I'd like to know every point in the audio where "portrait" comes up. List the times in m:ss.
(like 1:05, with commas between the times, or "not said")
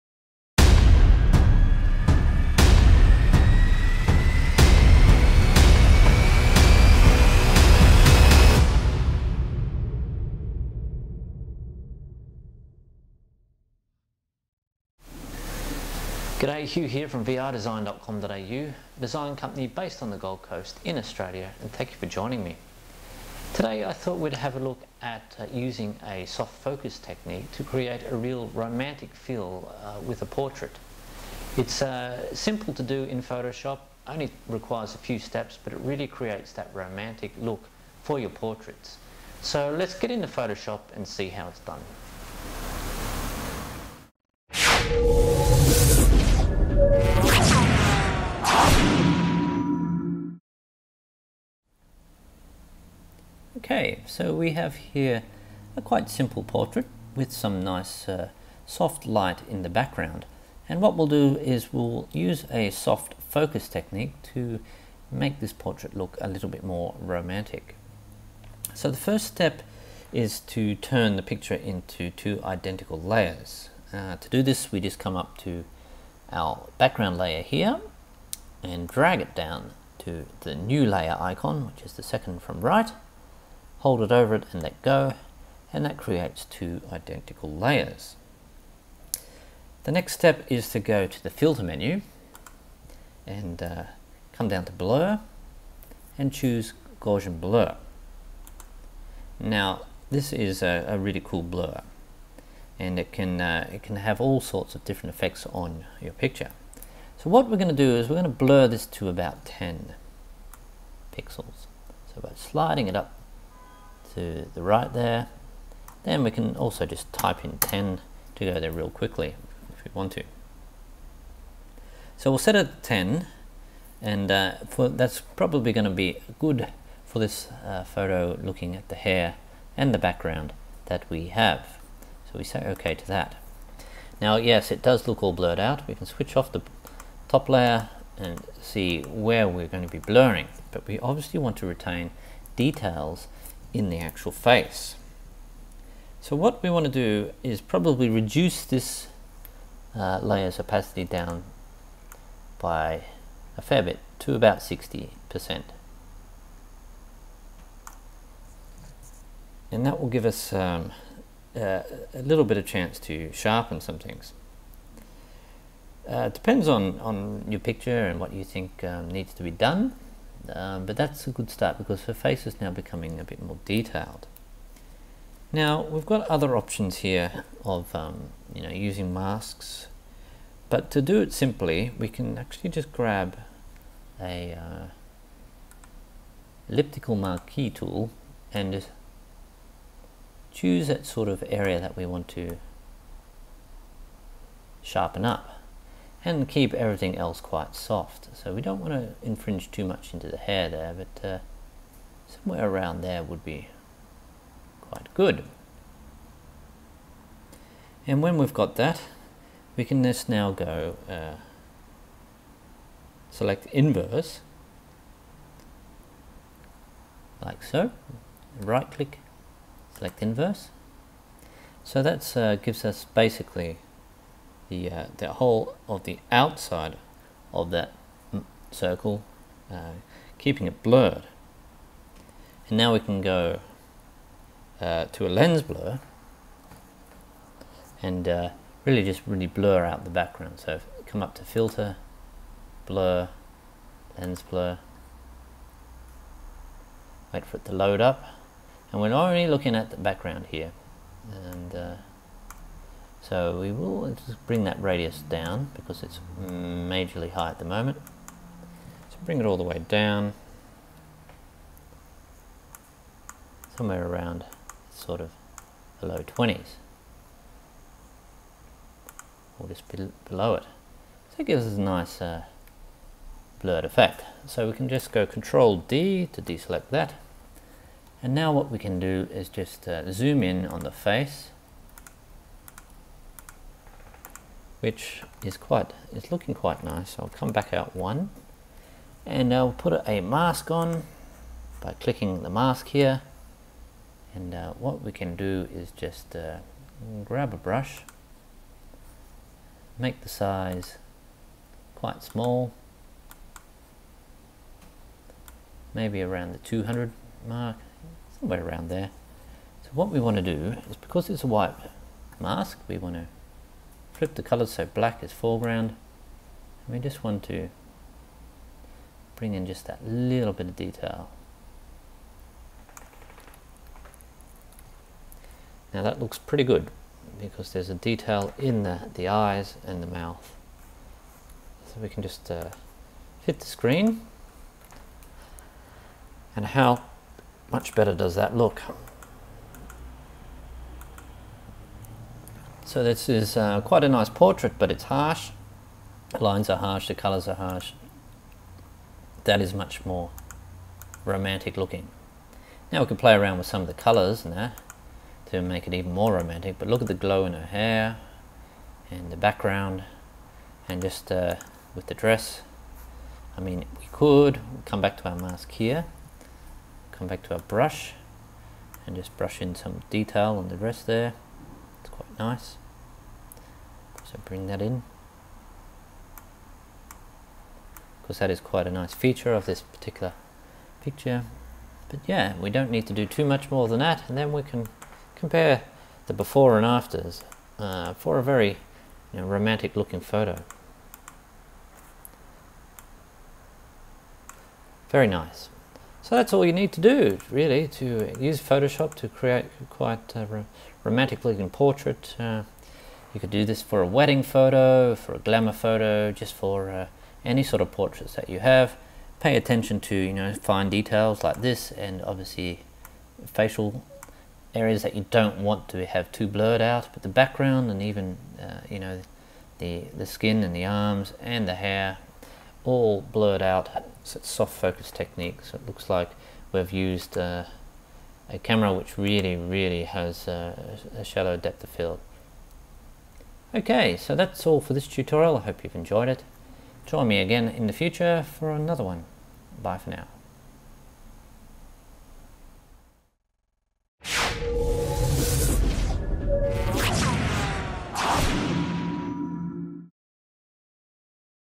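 0:30, 0:38, 0:56, 1:05, 5:44, 6:41, 6:47.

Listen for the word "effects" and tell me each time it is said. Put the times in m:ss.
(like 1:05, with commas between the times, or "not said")
1:45, 4:33.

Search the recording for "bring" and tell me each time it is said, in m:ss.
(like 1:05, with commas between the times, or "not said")
4:14, 4:19, 5:19, 6:14.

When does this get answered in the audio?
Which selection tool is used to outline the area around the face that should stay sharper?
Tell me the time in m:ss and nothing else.
3:06.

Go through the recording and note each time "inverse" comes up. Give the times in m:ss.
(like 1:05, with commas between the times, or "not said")
3:33, 3:40.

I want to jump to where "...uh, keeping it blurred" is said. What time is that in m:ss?
3:49.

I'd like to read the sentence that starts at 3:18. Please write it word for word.
So we don't want to infringe too much into the hair there, but uh, somewhere around there would be quite good.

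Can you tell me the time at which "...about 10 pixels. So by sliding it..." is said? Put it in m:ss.
1:49.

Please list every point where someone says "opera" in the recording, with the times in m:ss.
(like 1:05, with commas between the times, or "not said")
not said.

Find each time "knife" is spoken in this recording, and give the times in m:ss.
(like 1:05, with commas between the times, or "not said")
not said.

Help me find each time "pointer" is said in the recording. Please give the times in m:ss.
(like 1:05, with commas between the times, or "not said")
not said.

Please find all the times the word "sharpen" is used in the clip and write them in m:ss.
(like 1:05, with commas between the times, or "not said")
2:43, 3:14.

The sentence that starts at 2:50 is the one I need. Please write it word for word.
Um, but that's a good start because her face is now becoming a bit more detailed.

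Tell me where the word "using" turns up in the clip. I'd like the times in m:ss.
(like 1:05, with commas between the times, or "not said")
0:25, 2:58.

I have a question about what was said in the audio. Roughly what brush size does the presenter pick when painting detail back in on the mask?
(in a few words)
200.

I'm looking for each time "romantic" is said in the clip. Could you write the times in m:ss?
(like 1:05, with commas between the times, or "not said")
0:28, 0:36, 1:06, 5:51, 5:56, 6:29, 6:41.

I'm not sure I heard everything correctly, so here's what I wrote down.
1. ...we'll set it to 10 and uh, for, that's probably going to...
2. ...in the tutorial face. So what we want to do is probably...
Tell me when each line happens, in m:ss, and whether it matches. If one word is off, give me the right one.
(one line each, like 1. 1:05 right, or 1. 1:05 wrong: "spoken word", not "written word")
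1. 2:02 right
2. 2:23 wrong: "actual", not "tutorial".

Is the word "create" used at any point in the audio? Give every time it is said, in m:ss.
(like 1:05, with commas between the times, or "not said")
0:27, 0:36, 1:25, 6:39.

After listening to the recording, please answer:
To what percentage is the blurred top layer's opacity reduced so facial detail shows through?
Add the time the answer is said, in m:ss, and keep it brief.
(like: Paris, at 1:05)
60%, at 2:34.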